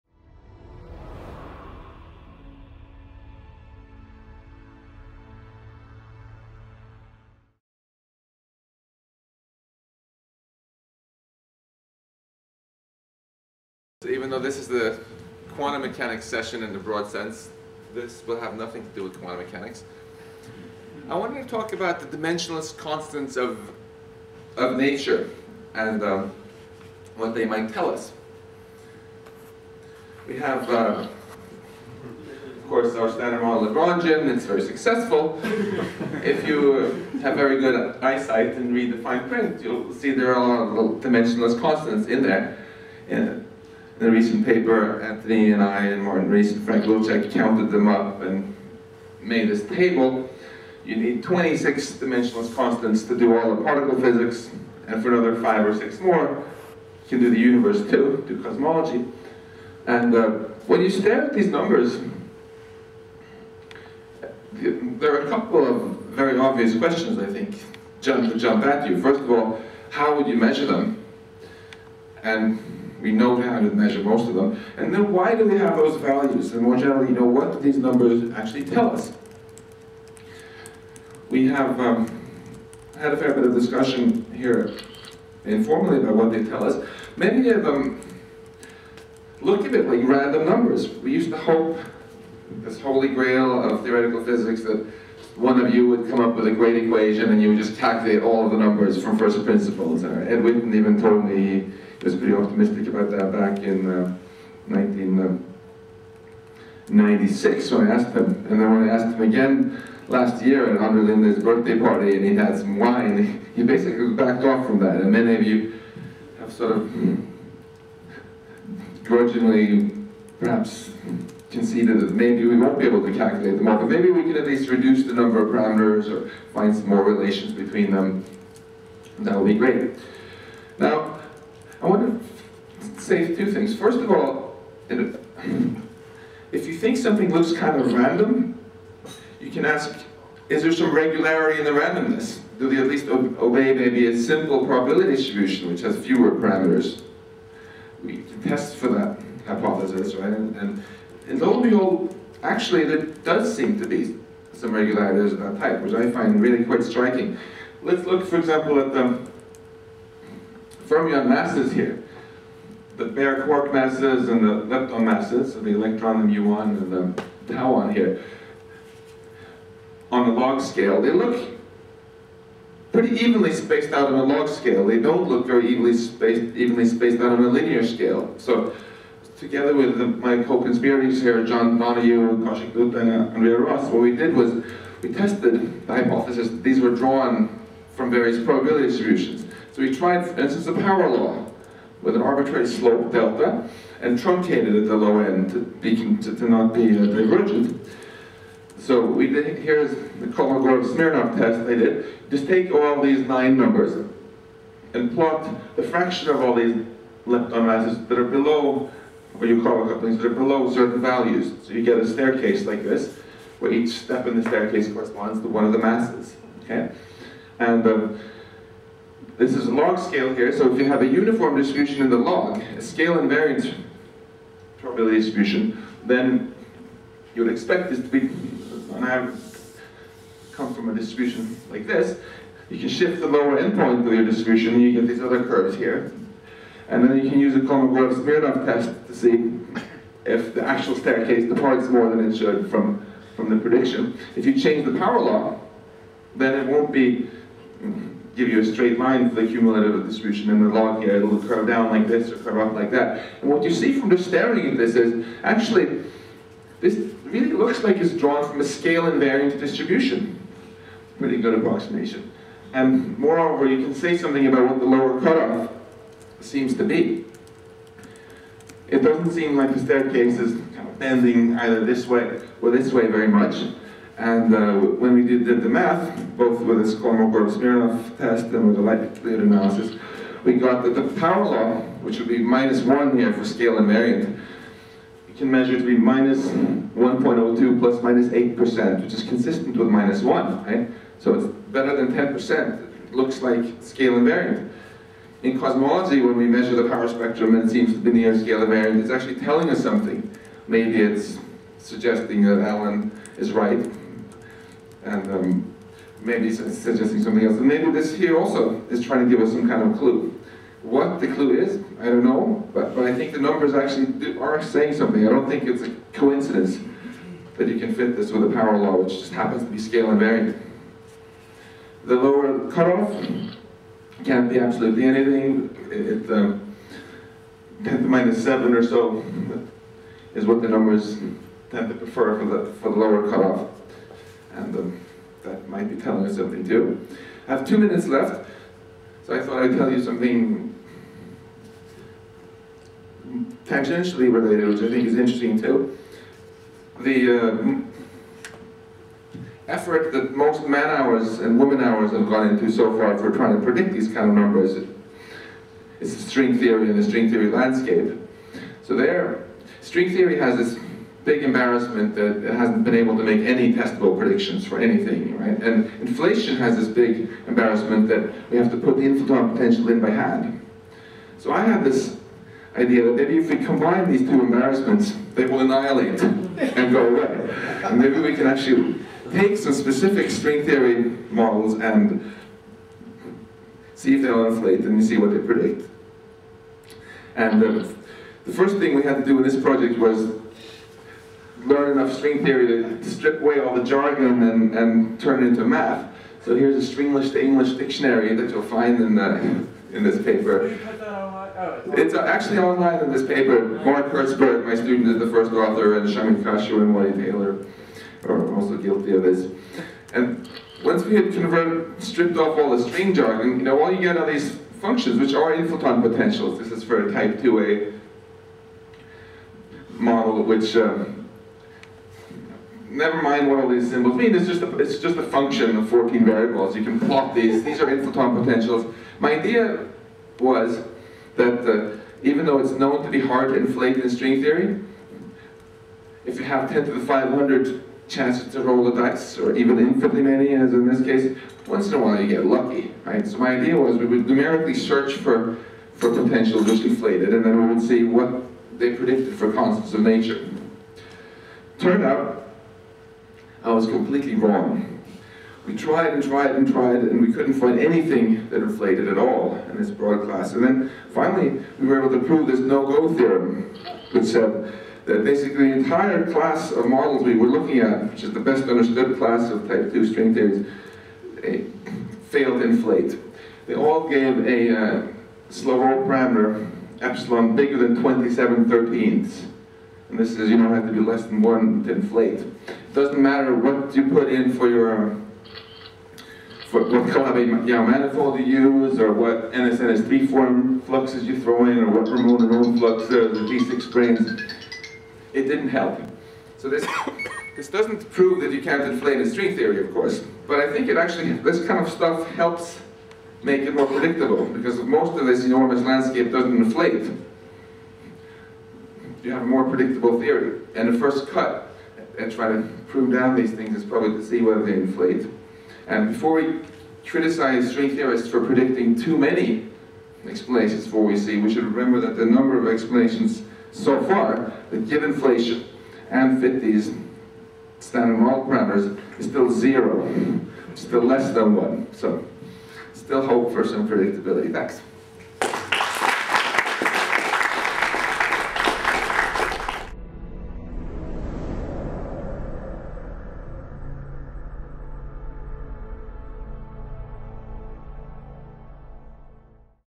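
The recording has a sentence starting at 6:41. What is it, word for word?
Oh, it's actually online in this paper.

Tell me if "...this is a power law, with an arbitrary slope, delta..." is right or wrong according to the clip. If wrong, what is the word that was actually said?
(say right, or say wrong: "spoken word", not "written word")
right.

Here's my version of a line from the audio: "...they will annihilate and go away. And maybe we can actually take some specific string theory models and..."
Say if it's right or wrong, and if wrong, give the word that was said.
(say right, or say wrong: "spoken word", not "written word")
right.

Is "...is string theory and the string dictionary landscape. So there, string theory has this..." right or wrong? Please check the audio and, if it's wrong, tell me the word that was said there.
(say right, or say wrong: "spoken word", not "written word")
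wrong: "theory", not "dictionary".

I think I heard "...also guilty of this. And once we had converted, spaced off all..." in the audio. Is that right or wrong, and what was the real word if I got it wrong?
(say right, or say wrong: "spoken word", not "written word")
wrong: "stripped", not "spaced".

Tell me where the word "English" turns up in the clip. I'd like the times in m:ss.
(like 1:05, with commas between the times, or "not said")
6:37.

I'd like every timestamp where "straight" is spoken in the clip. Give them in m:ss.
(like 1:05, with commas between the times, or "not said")
4:08.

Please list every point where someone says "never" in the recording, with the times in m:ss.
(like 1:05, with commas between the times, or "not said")
7:02.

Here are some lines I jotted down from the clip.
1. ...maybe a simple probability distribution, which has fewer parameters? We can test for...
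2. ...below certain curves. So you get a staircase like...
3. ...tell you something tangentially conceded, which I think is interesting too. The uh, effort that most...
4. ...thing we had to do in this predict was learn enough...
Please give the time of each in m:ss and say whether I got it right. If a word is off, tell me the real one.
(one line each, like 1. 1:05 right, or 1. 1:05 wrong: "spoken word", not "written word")
1. 2:23 right
2. 3:30 wrong: "values", not "curves"
3. 5:39 wrong: "related", not "conceded"
4. 6:28 wrong: "project", not "predict".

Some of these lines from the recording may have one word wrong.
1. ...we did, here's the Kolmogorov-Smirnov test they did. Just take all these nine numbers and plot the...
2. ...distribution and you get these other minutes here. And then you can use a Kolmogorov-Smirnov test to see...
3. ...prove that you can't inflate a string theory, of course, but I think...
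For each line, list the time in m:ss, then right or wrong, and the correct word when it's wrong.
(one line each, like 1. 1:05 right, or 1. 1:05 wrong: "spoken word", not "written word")
1. 3:19 right
2. 3:54 wrong: "curves", not "minutes"
3. 8:18 right.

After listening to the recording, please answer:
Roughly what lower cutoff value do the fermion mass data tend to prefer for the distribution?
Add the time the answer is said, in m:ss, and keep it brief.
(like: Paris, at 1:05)
10^-7, at 5:27.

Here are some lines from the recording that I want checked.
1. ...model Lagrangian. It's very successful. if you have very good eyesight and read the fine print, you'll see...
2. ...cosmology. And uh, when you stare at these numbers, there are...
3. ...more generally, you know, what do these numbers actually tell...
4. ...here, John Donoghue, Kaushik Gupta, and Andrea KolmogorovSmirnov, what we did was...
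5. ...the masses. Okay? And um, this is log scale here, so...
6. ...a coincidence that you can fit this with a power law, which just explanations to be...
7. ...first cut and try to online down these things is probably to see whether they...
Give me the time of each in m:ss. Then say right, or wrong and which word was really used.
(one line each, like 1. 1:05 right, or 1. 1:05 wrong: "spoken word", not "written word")
1. 0:33 right
2. 0:58 right
3. 1:16 right
4. 3:01 wrong: "Ross", not "KolmogorovSmirnov"
5. 3:35 right
6. 5:15 wrong: "happens", not "explanations"
7. 8:30 wrong: "prune", not "online".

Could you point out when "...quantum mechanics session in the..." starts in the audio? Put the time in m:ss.
0:15.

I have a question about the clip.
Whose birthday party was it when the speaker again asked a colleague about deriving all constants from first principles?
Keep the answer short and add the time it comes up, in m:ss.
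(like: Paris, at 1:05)
Andre Linde, at 1:50.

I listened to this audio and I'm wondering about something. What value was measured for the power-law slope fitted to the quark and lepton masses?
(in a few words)
-1.02.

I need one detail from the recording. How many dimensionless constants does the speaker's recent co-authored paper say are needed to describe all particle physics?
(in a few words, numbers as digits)
26.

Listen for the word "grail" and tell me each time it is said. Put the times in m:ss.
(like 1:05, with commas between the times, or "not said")
1:33.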